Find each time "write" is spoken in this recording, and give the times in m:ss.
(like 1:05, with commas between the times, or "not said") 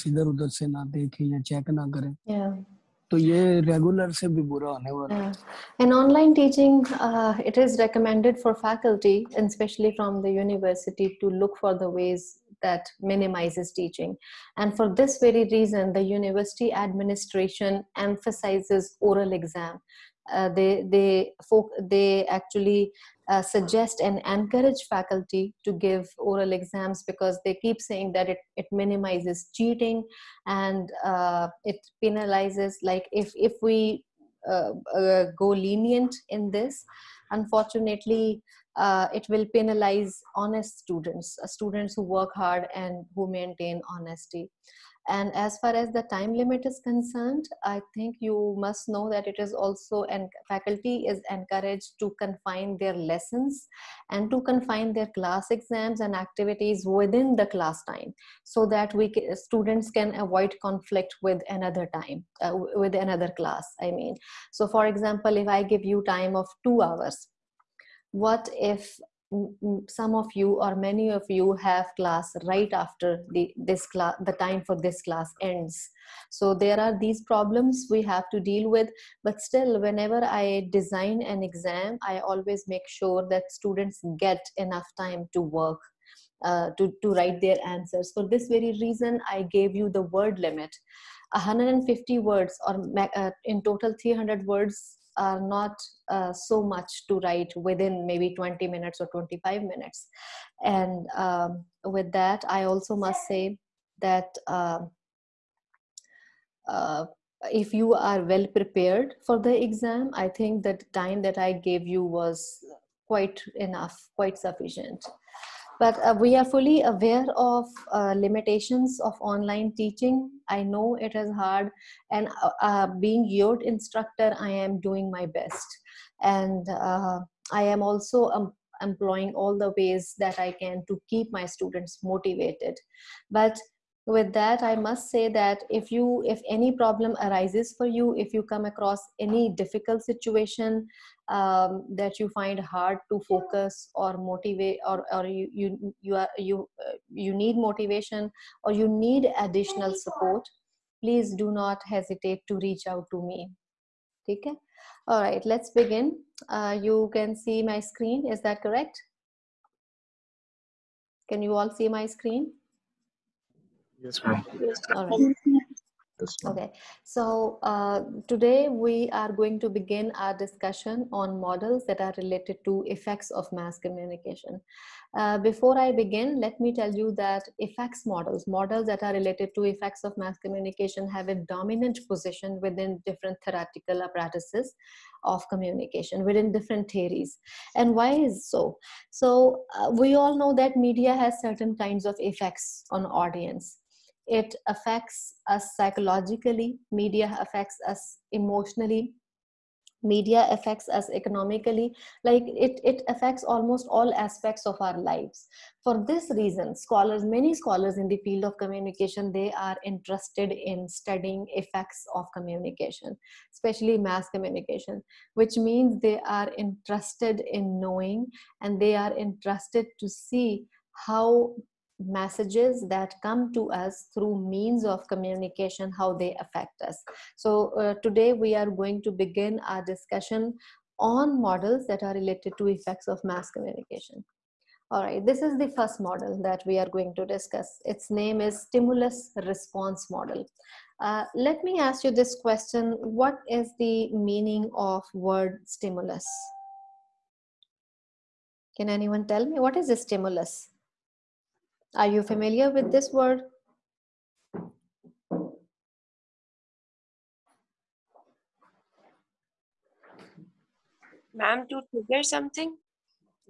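1:27, 1:37.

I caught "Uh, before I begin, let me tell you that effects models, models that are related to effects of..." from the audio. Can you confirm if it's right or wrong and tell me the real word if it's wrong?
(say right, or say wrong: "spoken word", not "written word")
right.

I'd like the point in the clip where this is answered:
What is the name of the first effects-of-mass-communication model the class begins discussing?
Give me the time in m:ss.
3:58.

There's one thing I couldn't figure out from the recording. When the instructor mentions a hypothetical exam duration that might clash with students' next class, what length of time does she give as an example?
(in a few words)
2 hours.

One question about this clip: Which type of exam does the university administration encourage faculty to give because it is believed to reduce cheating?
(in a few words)
Oral exam.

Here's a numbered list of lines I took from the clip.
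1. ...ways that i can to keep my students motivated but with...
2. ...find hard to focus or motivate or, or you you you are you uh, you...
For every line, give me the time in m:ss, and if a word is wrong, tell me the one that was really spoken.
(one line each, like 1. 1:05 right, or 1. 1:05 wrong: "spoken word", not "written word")
1. 2:09 right
2. 2:22 right.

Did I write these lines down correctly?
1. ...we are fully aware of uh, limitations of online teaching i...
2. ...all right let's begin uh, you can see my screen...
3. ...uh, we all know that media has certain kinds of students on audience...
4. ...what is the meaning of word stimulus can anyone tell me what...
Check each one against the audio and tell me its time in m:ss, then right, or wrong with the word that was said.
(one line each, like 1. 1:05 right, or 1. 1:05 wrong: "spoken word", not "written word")
1. 1:56 right
2. 2:35 right
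3. 3:09 wrong: "effects", not "students"
4. 4:02 right.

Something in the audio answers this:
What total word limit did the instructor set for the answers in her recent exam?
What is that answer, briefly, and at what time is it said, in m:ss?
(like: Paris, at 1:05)
300 words, at 1:34.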